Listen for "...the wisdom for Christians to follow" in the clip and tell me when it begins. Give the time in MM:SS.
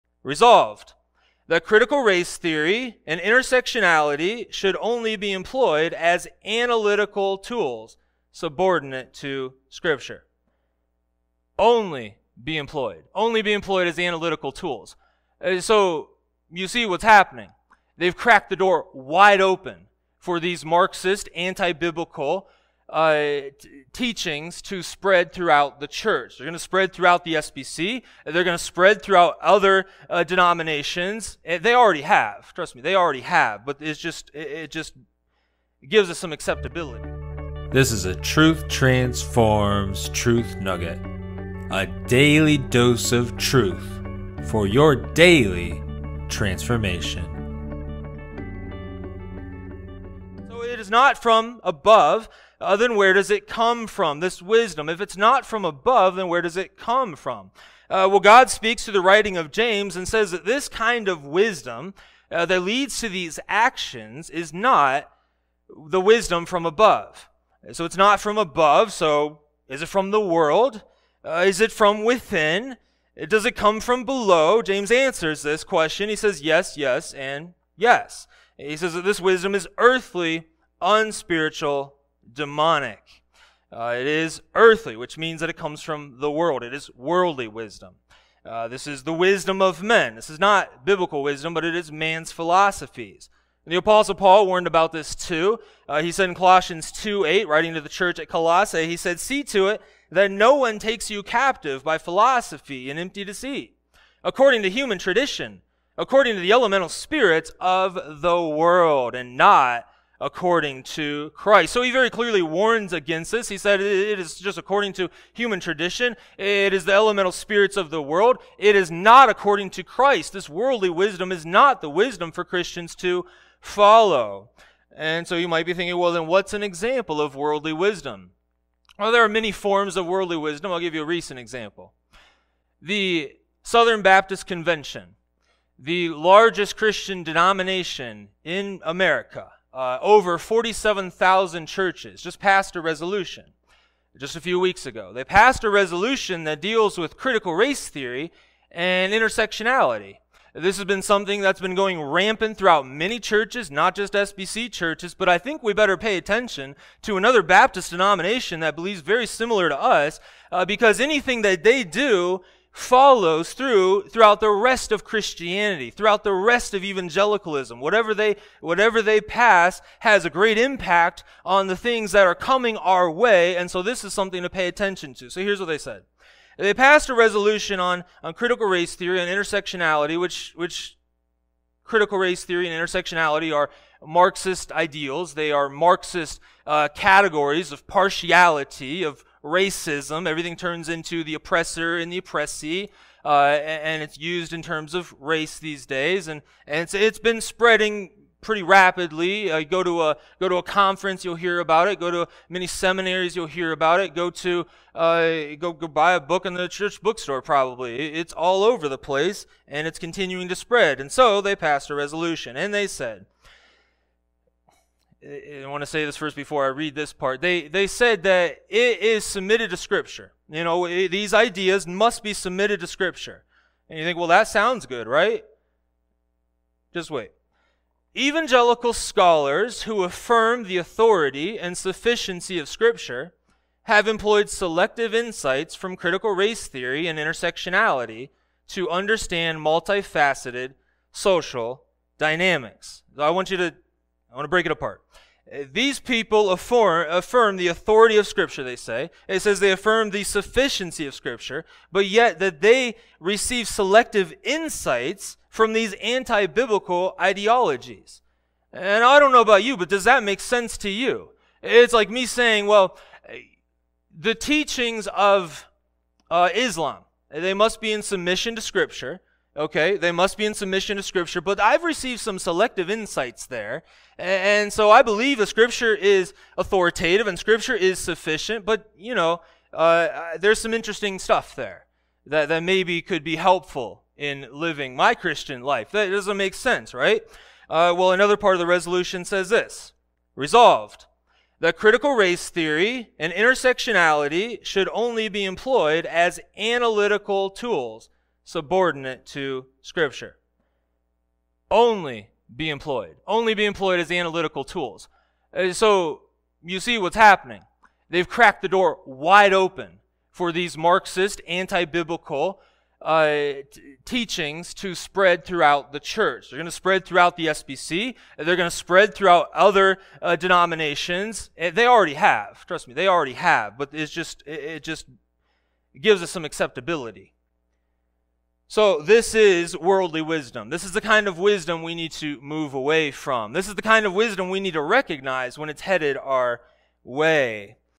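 02:01.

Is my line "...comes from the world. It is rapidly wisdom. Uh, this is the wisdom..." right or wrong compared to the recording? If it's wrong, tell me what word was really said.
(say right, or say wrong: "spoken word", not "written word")
wrong: "worldly", not "rapidly".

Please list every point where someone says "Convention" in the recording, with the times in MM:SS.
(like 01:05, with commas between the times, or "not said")
02:14.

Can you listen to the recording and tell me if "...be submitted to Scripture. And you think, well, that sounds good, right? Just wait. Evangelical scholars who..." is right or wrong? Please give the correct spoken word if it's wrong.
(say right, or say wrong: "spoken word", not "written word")
right.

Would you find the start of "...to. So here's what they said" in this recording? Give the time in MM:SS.
02:55.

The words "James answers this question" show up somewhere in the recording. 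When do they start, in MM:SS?
01:14.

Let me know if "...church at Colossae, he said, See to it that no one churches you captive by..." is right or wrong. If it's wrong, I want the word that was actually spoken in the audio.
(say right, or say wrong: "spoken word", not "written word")
wrong: "takes", not "churches".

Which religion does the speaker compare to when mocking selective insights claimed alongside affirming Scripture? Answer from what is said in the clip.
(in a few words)
Islam.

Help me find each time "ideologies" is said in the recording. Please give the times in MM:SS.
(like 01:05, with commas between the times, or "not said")
04:17.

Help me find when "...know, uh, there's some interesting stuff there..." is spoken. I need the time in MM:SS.
04:39.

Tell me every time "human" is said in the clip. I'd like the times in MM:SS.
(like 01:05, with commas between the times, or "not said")
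01:44, 01:55.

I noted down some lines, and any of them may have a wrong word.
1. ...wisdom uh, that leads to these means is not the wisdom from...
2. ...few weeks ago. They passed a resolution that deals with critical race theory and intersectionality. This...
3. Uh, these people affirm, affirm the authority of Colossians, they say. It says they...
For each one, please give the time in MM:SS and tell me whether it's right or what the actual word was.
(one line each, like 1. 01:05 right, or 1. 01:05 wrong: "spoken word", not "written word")
1. 01:01 wrong: "actions", not "means"
2. 02:24 right
3. 04:05 wrong: "Scripture", not "Colossians".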